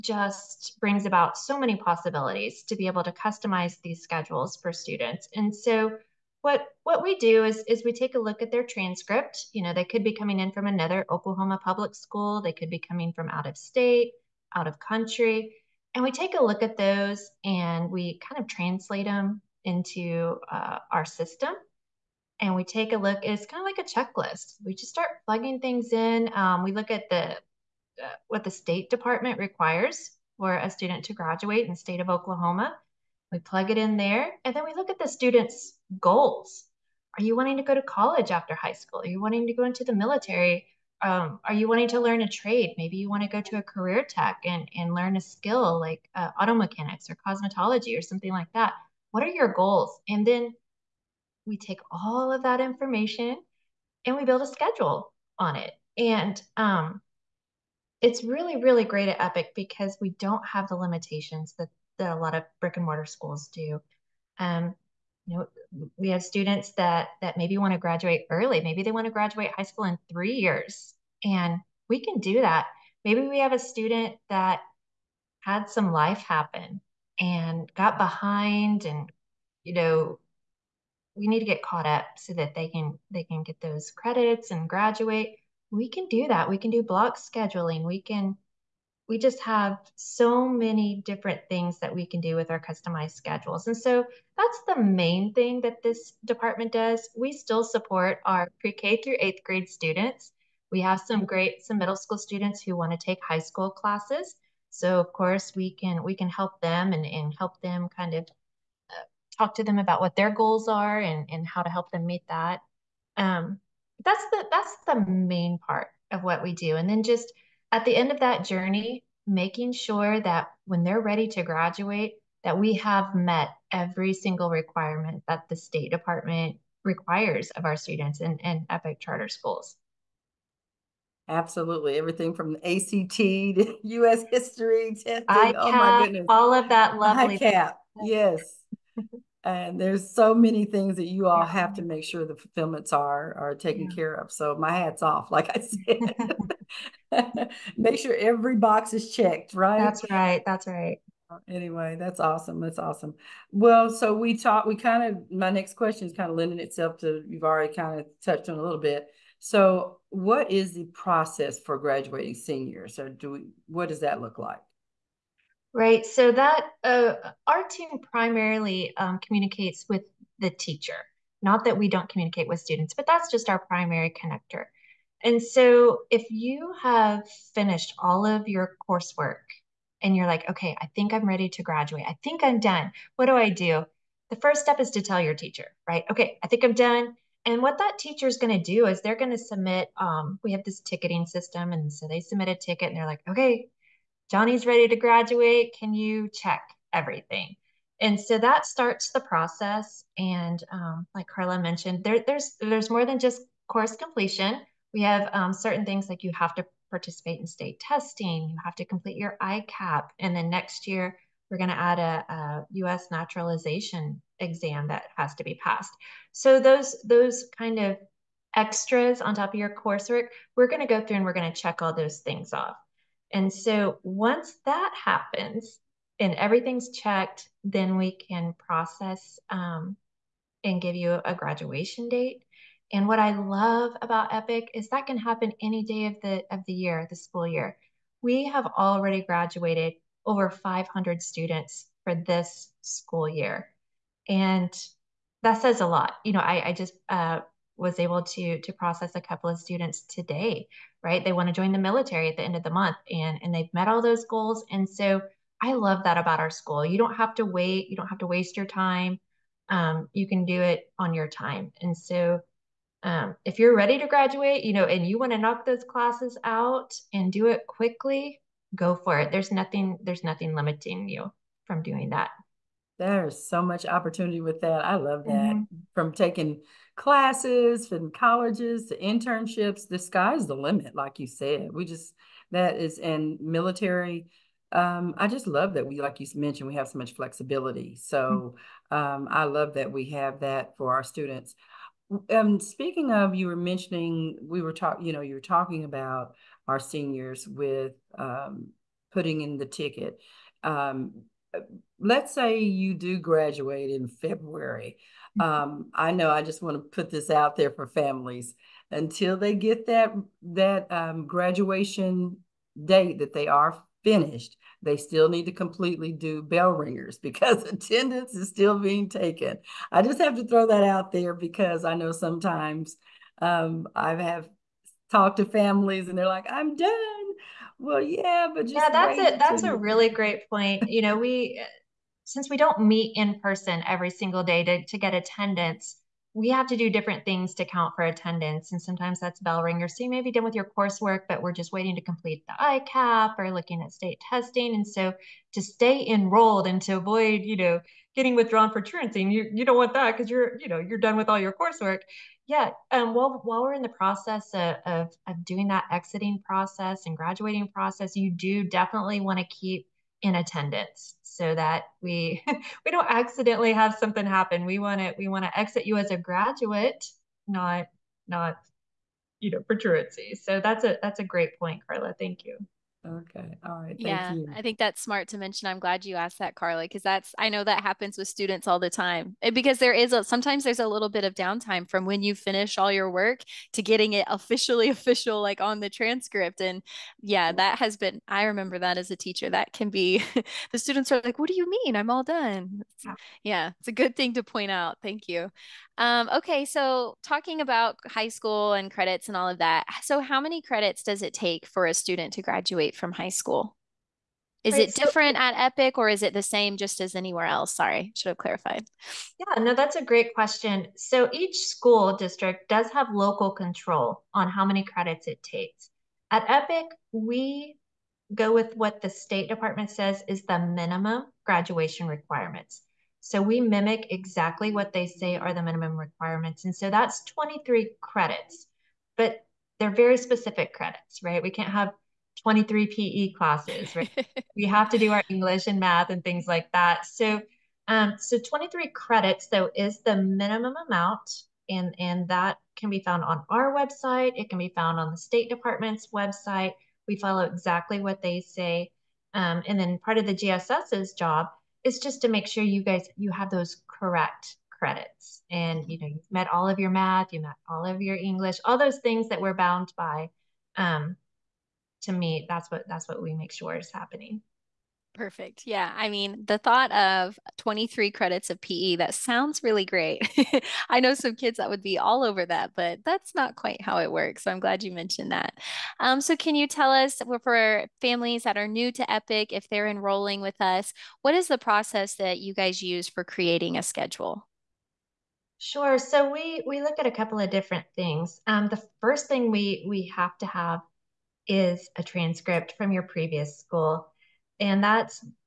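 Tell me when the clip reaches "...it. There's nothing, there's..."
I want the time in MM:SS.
04:29.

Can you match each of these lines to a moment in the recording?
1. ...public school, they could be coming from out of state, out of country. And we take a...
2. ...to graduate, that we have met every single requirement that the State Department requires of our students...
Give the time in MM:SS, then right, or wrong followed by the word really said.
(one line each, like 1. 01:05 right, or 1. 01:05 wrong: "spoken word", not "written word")
1. 00:11 right
2. 02:01 right.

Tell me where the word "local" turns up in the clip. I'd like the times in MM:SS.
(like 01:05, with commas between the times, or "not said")
06:53.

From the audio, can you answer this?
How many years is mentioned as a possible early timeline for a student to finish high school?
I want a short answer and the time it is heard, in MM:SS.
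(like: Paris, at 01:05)
3, at 01:10.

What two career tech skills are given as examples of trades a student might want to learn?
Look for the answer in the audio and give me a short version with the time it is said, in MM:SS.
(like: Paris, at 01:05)
auto mechanics or cosmetology, at 00:46.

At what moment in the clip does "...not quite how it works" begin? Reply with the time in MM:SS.
07:53.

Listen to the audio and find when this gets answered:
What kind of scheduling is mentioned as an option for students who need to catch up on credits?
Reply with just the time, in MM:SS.
01:26.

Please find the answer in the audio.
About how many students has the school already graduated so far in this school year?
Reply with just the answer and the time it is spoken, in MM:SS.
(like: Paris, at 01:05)
over 500, at 04:00.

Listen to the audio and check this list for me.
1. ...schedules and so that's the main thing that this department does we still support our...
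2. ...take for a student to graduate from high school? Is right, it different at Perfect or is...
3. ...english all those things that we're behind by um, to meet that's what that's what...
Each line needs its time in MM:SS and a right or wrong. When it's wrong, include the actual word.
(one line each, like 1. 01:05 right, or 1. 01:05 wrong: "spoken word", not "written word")
1. 01:33 right
2. 06:41 wrong: "Epic", not "Perfect"
3. 07:38 wrong: "bound", not "behind".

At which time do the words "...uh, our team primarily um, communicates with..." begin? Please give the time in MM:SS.
02:46.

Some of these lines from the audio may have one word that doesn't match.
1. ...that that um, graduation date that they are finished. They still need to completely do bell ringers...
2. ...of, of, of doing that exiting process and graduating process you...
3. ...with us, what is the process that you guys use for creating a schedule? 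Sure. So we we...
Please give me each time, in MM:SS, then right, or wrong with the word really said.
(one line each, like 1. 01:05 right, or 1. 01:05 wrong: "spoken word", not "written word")
1. 05:09 right
2. 05:54 right
3. 08:00 right.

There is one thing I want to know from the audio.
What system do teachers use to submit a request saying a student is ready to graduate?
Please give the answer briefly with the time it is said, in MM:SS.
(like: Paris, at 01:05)
ticketing system, at 03:10.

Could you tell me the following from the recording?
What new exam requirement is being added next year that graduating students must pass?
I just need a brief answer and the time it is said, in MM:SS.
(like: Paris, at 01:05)
U.S. naturalization exam, at 03:32.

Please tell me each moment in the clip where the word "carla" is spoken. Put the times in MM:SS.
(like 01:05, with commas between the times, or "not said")
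03:21, 06:11, 06:16.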